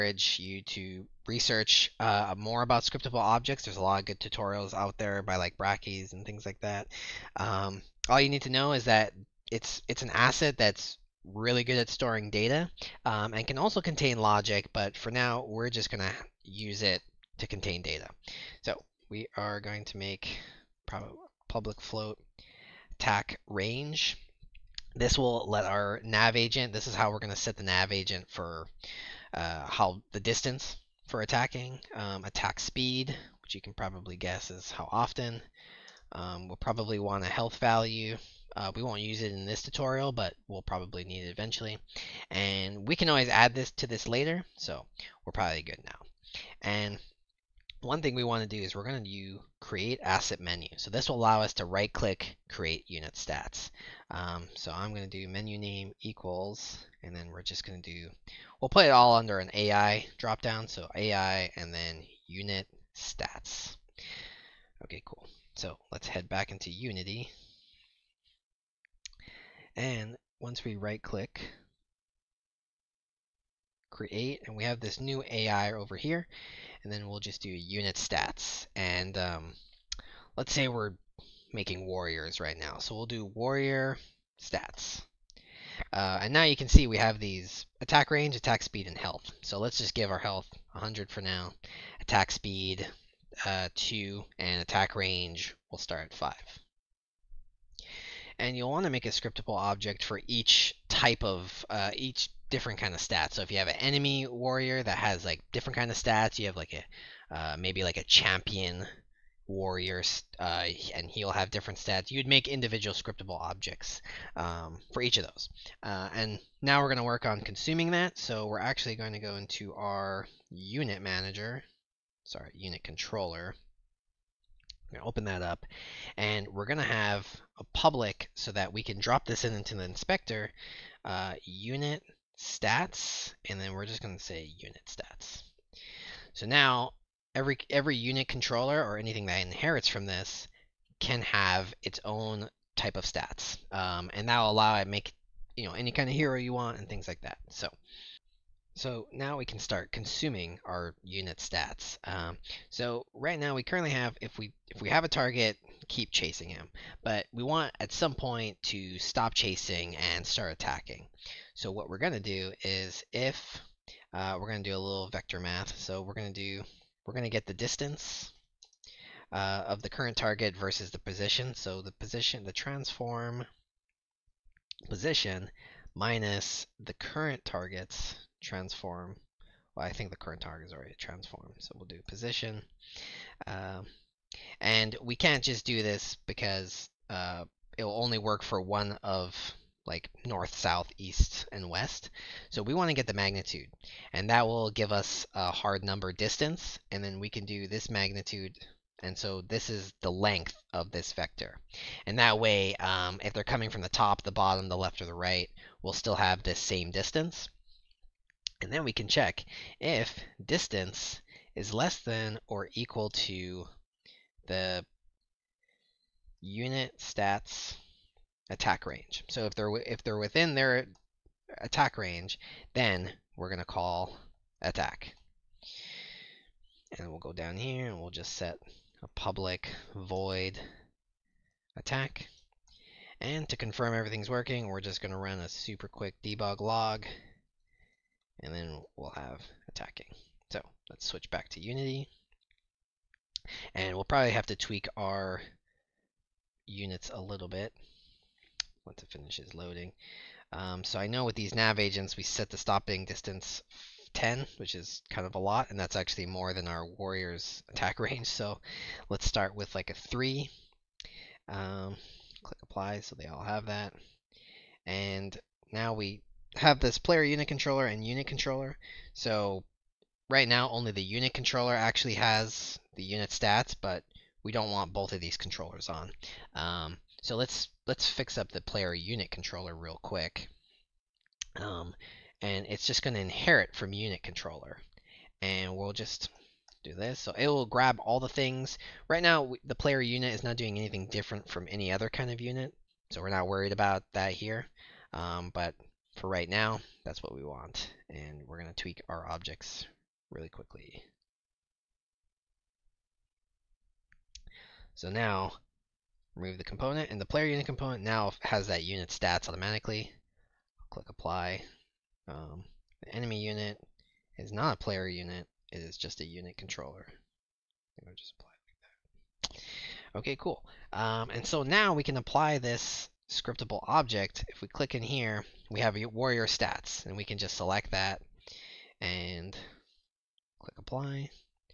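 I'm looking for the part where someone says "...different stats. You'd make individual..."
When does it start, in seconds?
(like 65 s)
111 s.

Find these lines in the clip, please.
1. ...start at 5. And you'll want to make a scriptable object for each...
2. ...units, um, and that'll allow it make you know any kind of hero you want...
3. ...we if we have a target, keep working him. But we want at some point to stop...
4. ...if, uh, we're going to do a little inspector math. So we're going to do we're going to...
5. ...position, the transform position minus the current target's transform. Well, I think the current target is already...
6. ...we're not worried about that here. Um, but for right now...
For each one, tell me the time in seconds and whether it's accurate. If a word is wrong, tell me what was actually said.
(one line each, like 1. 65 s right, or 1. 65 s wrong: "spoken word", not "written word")
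1. 95 s right
2. 143 s wrong: "stats", not "units"
3. 154 s wrong: "chasing", not "working"
4. 163 s wrong: "vector", not "inspector"
5. 171 s right
6. 293 s right.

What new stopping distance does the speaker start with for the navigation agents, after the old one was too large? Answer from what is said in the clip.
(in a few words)
3.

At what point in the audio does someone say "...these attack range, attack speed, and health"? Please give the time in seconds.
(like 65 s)
87 s.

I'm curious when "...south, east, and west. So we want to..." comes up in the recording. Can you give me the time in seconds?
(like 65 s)
190 s.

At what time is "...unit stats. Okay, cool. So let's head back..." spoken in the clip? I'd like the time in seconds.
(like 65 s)
62 s.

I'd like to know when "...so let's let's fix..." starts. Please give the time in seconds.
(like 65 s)
277 s.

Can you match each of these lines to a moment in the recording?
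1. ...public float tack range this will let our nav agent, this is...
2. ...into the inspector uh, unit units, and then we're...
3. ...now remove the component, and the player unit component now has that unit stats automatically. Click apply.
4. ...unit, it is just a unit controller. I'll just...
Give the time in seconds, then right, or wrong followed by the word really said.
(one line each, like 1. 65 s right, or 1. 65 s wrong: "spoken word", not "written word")
1. 21 s right
2. 129 s wrong: "stats", not "units"
3. 305 s right
4. 315 s right.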